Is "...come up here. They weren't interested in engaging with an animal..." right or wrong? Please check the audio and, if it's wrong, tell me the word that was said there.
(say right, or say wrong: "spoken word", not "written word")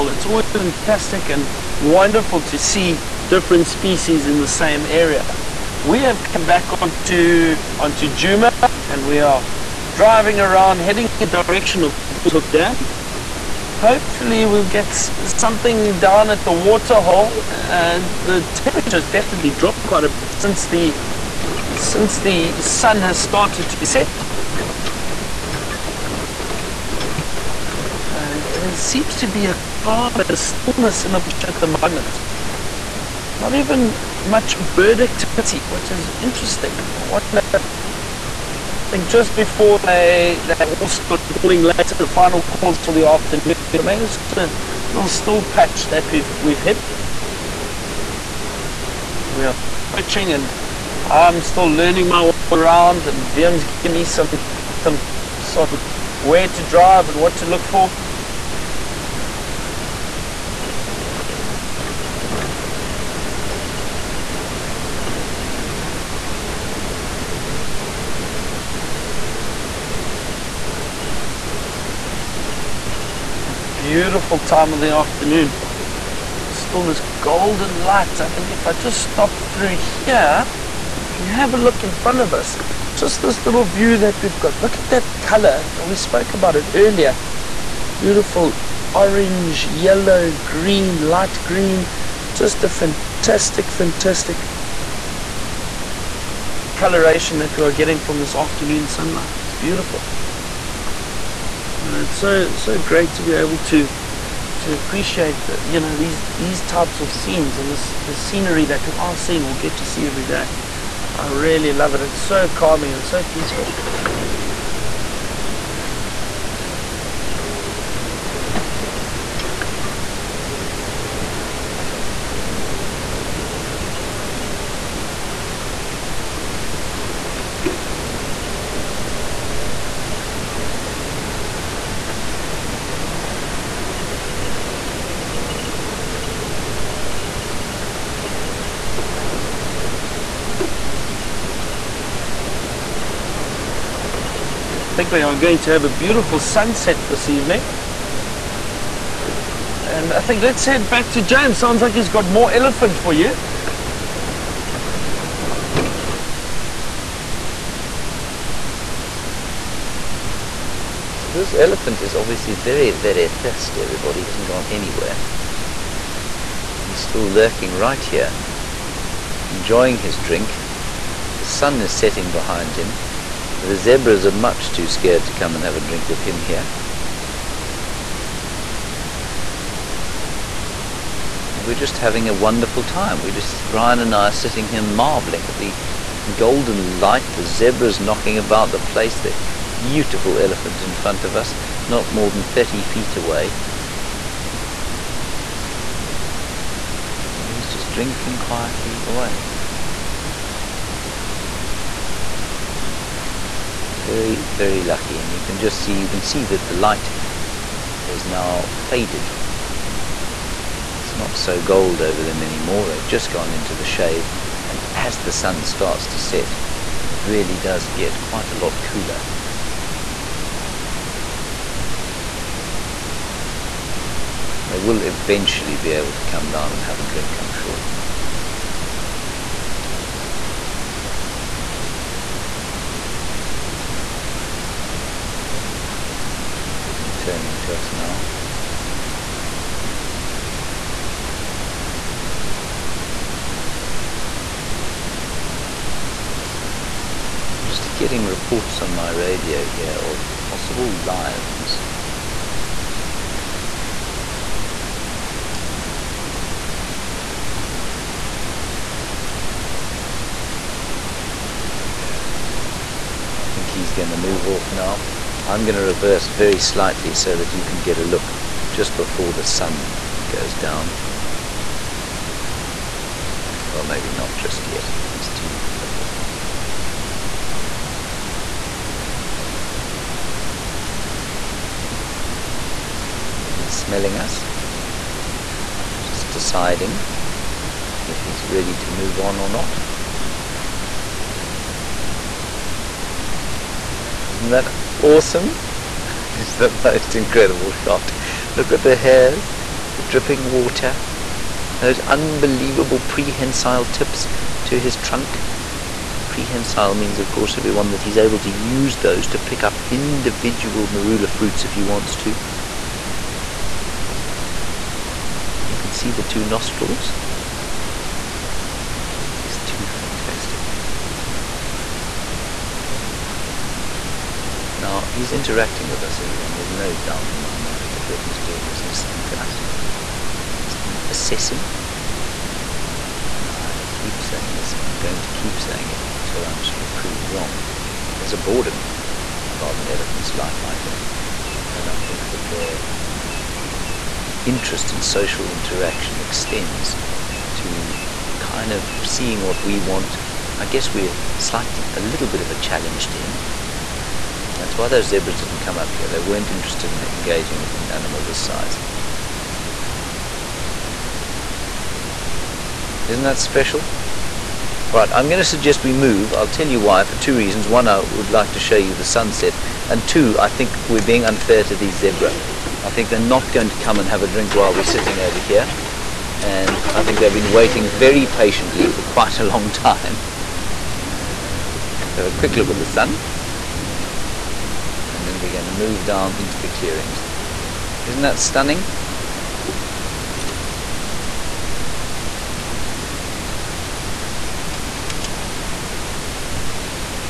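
right.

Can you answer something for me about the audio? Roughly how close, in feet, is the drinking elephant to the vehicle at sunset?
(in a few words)
30.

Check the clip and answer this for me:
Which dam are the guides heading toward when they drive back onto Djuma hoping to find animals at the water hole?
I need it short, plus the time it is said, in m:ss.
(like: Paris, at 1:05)
Falls Hook Dam, at 0:12.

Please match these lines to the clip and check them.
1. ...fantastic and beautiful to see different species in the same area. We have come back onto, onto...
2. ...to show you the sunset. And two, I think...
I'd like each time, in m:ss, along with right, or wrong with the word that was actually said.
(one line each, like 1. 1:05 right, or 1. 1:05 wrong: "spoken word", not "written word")
1. 0:00 wrong: "wonderful", not "beautiful"
2. 6:08 right.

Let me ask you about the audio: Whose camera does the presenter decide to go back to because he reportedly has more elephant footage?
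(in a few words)
James.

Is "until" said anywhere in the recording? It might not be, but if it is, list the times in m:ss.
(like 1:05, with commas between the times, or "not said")
5:36.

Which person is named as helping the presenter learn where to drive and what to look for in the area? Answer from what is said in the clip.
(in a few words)
Vim.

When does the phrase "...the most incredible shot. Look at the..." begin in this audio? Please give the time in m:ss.
4:56.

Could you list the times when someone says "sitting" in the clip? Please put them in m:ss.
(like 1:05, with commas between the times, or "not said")
3:04, 6:14.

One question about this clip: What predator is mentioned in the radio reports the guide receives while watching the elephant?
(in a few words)
lions.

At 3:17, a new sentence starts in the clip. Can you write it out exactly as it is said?
And he's just drinking quietly away.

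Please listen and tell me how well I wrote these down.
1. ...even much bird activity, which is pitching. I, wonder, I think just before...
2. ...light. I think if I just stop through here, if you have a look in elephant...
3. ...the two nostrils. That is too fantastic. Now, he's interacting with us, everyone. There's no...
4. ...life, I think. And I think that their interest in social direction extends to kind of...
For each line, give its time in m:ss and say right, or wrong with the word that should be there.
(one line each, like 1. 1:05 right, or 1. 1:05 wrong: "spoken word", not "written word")
1. 0:33 wrong: "interesting", not "pitching"
2. 1:17 wrong: "front", not "elephant"
3. 5:16 right
4. 5:40 wrong: "interaction", not "direction".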